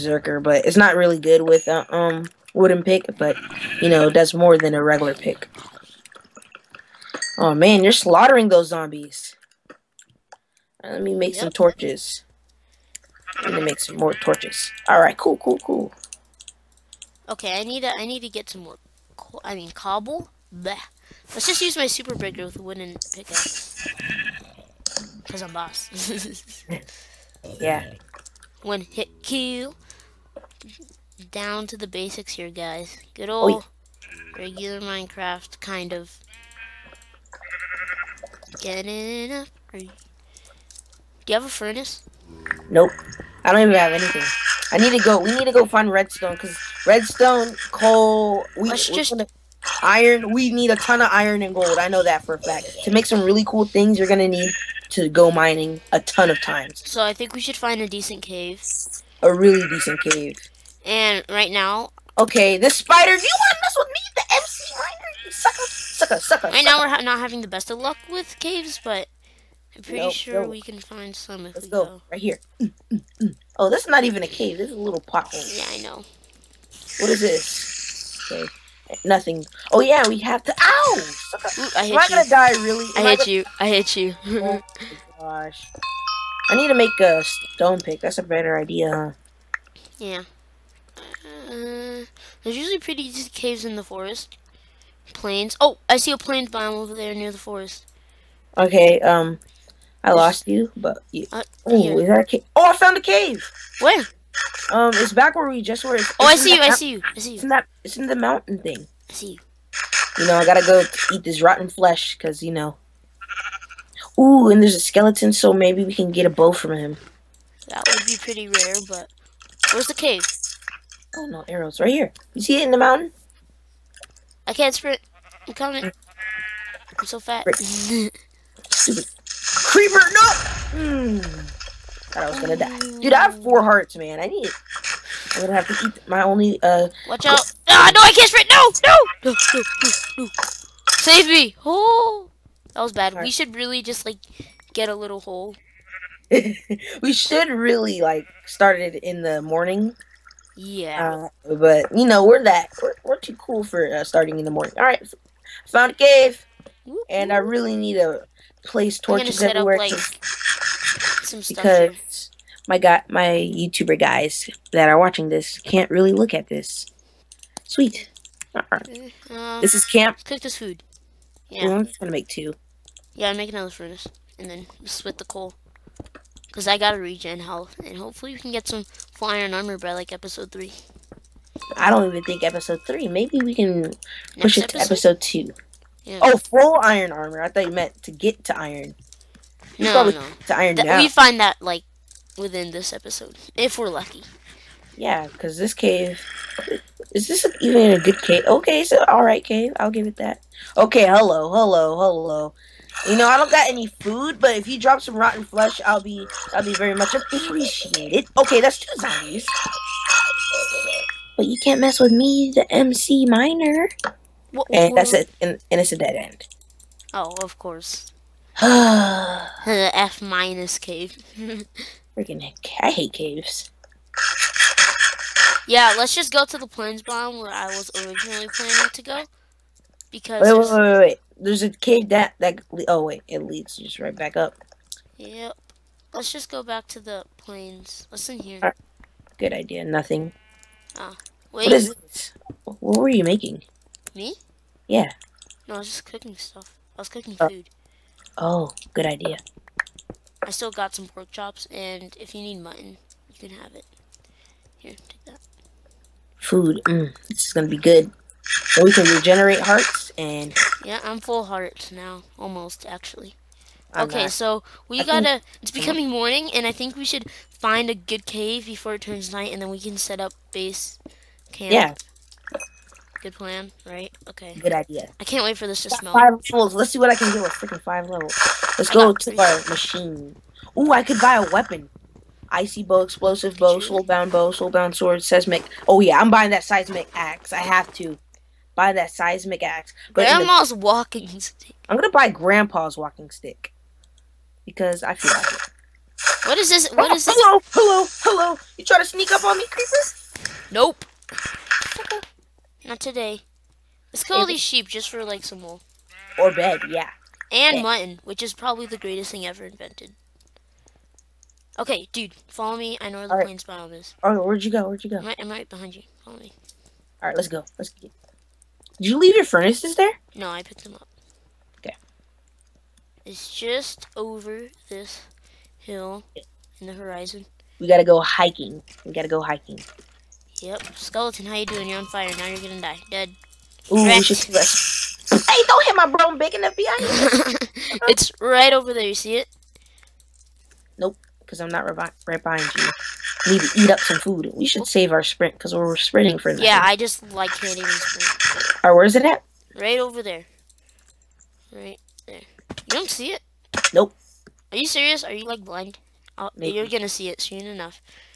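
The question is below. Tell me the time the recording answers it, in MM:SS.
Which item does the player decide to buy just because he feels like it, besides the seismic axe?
04:52.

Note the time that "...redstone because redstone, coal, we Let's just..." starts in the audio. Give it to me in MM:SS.
00:45.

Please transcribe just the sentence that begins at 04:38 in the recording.
Let's I go to our machine.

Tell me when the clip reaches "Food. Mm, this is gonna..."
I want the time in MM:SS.
04:16.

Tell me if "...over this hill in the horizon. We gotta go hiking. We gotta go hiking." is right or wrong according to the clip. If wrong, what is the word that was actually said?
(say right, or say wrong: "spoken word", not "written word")
right.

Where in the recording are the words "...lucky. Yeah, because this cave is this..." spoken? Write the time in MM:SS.
03:13.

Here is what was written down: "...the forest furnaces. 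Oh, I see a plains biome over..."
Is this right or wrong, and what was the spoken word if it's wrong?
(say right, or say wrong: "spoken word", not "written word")
wrong: "planes", not "furnaces".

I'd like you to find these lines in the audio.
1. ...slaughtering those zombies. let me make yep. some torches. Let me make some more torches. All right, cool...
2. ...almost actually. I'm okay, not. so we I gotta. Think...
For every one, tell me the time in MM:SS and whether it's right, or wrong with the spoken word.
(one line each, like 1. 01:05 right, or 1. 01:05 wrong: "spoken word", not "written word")
1. 00:07 right
2. 04:22 right.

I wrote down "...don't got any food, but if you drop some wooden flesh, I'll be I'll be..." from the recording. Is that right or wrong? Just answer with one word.
wrong.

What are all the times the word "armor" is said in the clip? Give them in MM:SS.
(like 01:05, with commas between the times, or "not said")
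02:59, 03:07.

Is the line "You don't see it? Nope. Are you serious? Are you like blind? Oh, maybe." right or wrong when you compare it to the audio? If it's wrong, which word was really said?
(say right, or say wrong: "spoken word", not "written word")
right.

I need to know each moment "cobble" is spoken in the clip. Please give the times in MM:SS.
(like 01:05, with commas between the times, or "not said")
00:19.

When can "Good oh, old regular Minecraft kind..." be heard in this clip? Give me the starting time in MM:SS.
00:33.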